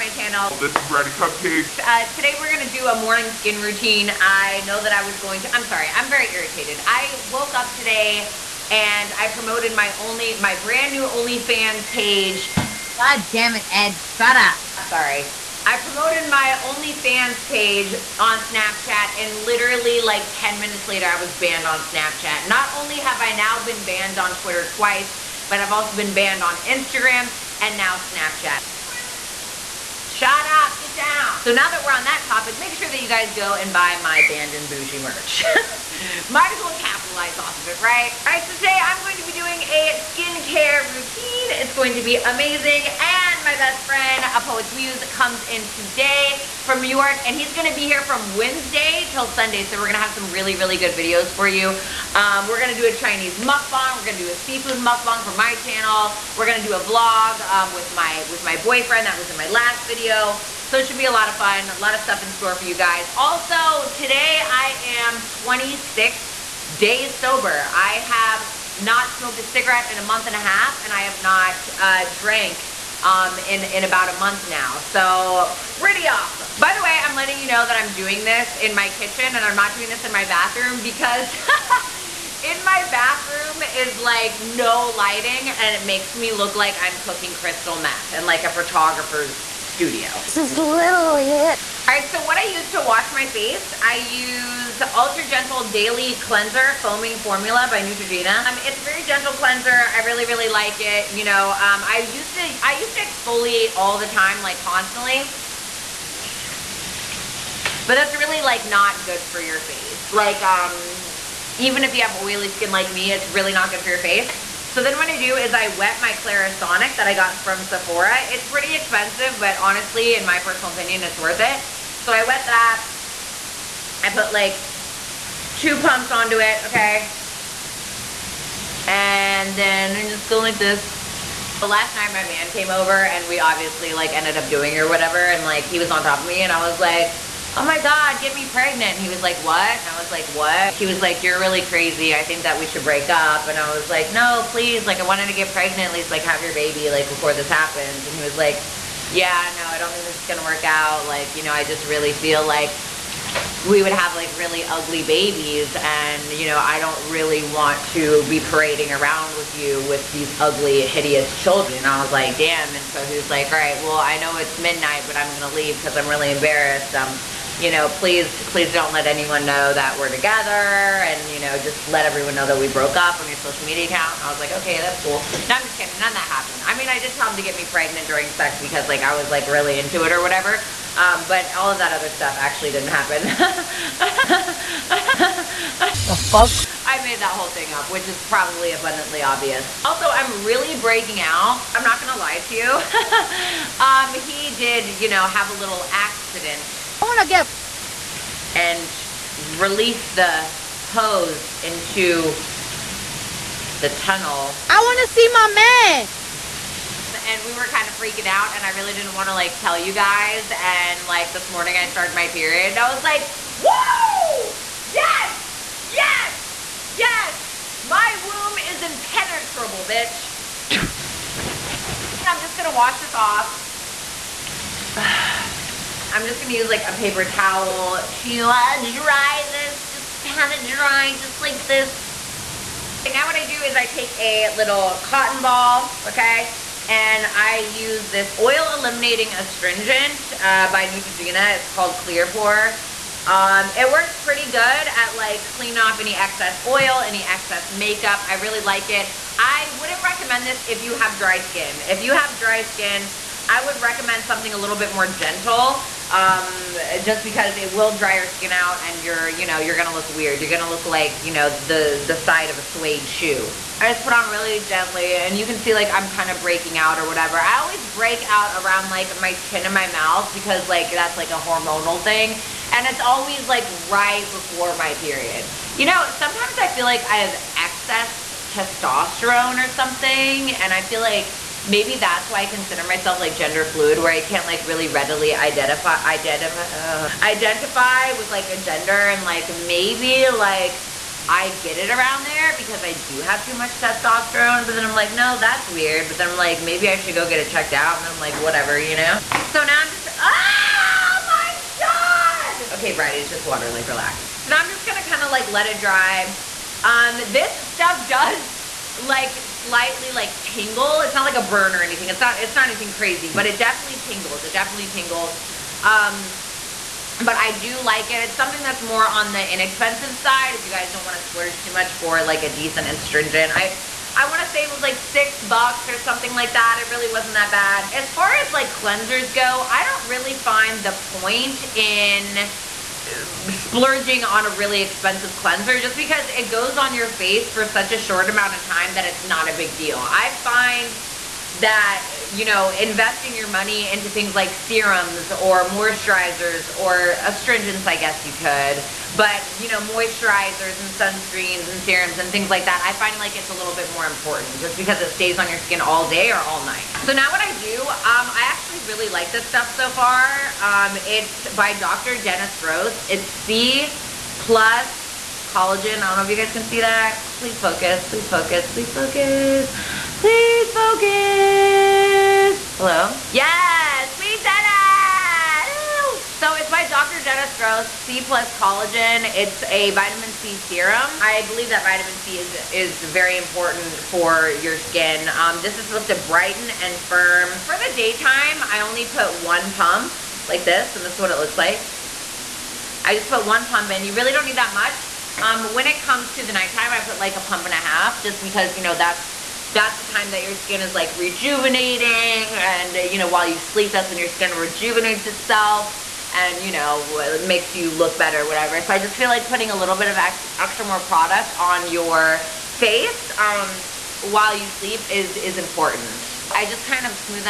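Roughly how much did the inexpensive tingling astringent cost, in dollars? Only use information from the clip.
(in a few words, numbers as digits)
$6.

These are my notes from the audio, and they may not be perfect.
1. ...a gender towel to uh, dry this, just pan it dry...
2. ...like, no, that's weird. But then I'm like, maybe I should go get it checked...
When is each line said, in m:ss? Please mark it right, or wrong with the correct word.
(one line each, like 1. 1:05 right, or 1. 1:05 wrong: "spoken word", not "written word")
1. 3:46 wrong: "paper", not "gender"
2. 4:54 right.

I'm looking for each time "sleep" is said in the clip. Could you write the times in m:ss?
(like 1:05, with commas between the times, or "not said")
6:43, 6:54.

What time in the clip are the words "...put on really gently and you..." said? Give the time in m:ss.
4:24.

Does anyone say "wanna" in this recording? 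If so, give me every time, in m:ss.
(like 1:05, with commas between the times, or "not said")
3:17, 3:24.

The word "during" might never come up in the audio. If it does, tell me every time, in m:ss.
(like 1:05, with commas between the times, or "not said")
2:58.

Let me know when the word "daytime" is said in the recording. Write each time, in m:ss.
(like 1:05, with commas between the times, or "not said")
6:27.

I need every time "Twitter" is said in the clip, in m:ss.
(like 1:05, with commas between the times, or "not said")
0:24.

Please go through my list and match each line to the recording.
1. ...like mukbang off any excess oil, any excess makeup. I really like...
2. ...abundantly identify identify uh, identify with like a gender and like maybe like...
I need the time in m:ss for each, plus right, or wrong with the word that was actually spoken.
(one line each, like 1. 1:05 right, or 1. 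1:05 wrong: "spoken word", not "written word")
1. 4:05 wrong: "cleaning", not "mukbang"
2. 4:44 wrong: "readily", not "abundantly".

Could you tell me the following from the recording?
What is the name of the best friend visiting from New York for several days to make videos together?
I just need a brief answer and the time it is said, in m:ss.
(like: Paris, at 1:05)
A Poet's Muse, at 0:44.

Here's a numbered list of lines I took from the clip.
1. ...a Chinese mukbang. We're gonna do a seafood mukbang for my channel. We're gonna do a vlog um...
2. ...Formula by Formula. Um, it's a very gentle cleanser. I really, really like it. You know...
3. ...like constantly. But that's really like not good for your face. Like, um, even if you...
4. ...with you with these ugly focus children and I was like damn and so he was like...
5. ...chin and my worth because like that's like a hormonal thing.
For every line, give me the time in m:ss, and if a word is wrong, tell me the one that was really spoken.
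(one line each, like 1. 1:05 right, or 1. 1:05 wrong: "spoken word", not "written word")
1. 0:52 right
2. 1:37 wrong: "Neutrogena", not "Formula"
3. 1:44 right
4. 2:39 wrong: "hideous", not "focus"
5. 4:29 wrong: "mouth", not "worth".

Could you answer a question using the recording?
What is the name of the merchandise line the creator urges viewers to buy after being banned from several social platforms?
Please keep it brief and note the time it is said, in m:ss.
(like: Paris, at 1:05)
Banned and Bougie, at 0:34.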